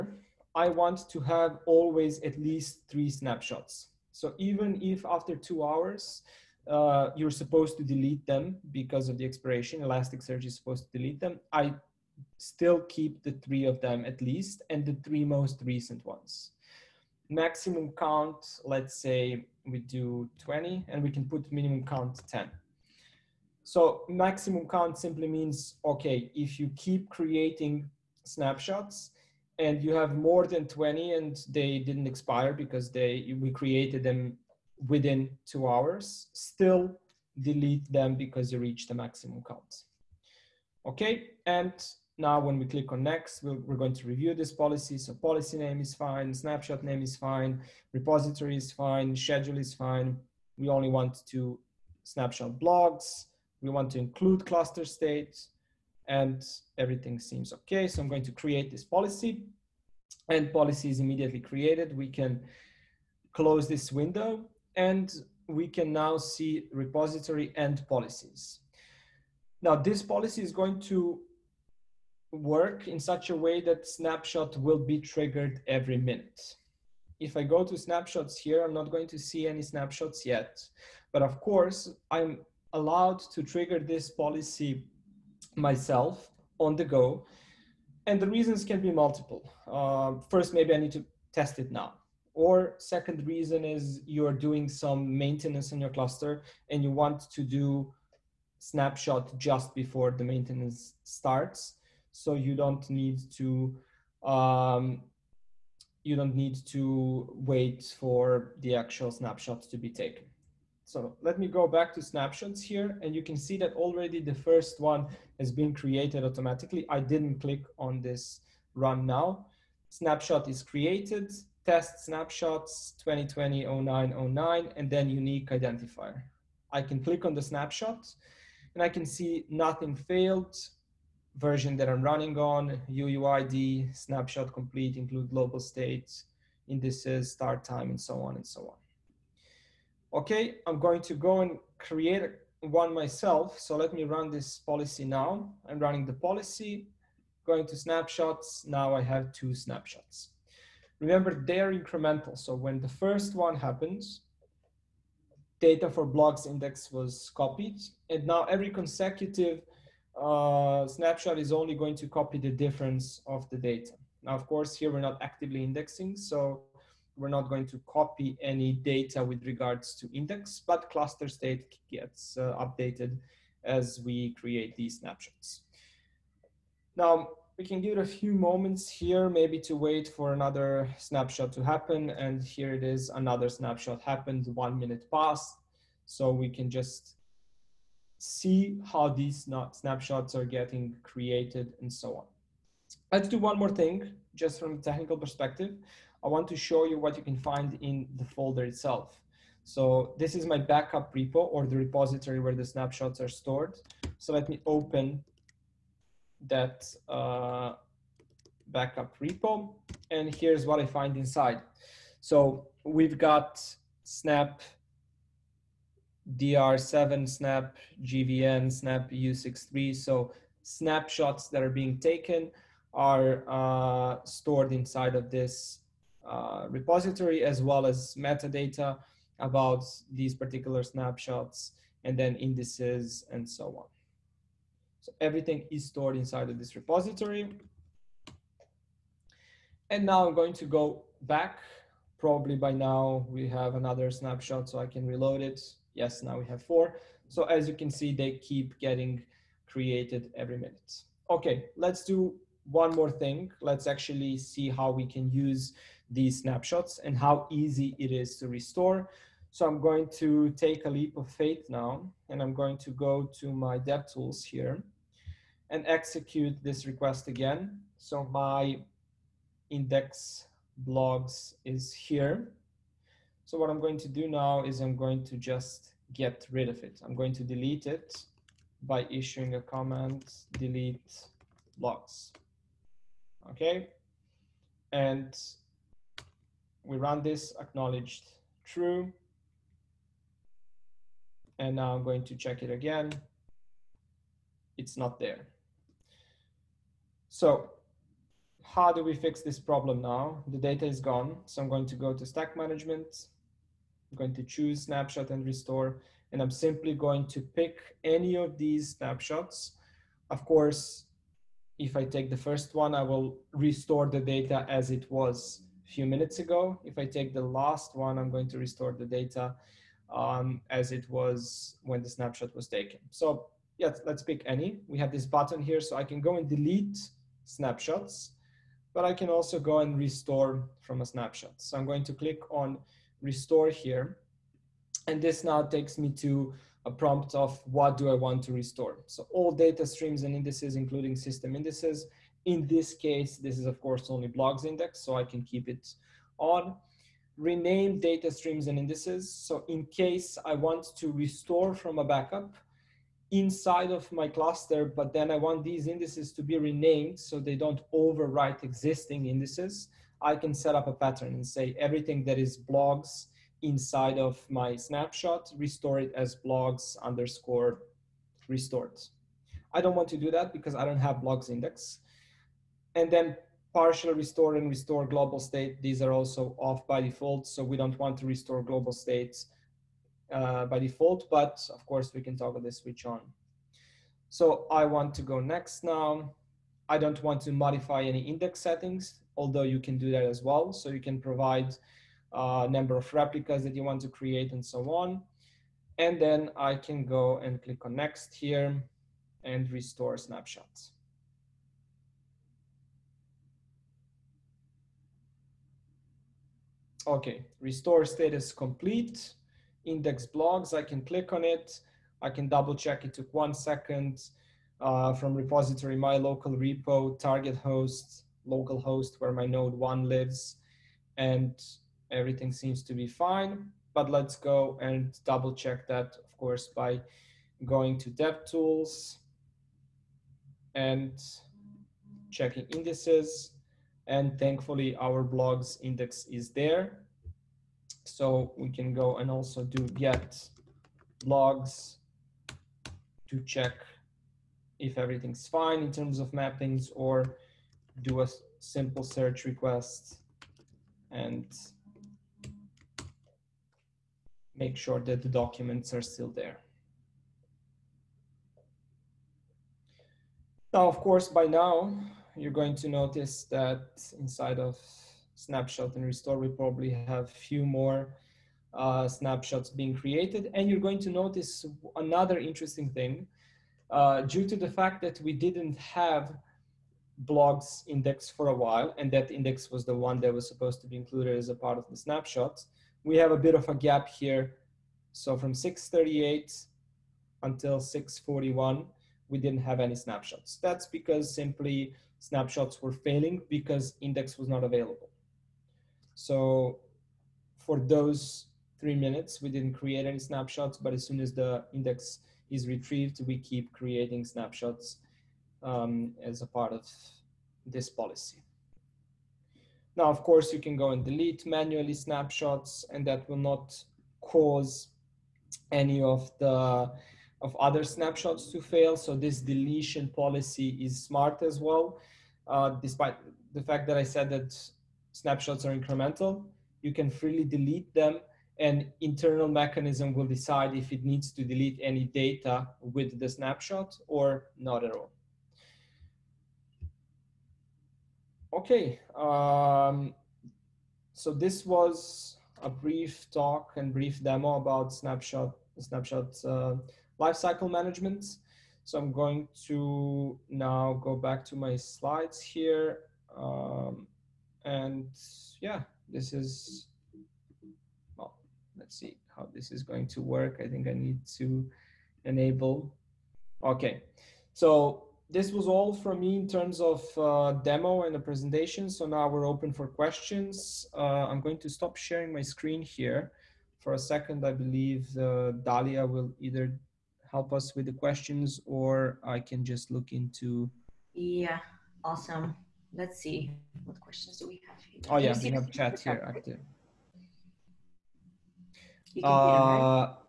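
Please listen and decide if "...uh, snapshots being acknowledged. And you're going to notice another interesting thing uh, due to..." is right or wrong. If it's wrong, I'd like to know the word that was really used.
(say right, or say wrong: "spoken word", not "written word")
wrong: "created", not "acknowledged".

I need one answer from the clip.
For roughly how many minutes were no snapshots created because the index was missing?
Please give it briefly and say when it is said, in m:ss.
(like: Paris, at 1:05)
3, at 8:18.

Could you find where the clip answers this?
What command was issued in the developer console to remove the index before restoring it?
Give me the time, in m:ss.
4:40.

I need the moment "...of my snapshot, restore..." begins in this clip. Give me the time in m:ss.
6:04.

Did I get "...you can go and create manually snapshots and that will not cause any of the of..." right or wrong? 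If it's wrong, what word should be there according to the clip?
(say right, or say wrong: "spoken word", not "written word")
wrong: "delete", not "create".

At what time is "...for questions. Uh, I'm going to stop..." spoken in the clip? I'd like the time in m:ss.
9:29.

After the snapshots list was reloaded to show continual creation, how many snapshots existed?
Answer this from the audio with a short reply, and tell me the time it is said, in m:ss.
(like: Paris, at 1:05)
4, at 4:06.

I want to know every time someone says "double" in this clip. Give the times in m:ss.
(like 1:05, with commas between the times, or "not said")
6:52, 7:05.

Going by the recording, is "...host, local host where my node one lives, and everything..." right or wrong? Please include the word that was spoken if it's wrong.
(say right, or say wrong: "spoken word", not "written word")
right.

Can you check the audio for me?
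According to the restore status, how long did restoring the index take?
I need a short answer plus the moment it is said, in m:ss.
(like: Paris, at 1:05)
1 second, at 6:53.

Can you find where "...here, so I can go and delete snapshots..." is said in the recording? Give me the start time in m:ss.
5:25.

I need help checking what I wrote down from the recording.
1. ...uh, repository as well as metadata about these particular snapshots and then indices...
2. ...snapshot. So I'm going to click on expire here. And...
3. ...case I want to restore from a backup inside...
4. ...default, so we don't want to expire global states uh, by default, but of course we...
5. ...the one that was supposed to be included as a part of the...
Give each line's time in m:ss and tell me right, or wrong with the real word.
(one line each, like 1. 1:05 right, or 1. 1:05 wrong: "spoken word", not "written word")
1. 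3:46 right
2. 5:31 wrong: "restore", not "expire"
3. 5:49 right
4. 6:17 wrong: "restore", not "expire"
5. 7:59 right.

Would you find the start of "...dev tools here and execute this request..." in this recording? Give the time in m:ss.
4:23.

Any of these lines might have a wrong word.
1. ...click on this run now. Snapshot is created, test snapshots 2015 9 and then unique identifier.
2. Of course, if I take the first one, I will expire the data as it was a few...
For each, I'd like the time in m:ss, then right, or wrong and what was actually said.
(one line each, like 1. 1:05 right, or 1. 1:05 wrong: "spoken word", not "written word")
1. 1:57 wrong: "2020", not "2015"
2. 5:10 wrong: "restore", not "expire".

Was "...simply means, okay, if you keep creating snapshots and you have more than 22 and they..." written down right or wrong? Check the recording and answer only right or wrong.
wrong.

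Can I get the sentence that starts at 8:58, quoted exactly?
Okay, um, so this was a brief talk and brief demo about snapshot, snapshot uh, lifecycle management.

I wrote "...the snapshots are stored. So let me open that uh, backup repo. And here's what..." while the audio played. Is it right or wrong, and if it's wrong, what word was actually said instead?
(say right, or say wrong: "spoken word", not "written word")
right.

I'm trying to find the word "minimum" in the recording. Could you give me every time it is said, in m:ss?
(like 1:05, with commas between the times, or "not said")
0:21.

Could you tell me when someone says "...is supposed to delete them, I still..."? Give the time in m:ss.
0:10.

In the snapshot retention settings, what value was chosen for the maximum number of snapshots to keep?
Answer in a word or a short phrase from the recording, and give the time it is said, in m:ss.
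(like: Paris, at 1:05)
20, at 0:17.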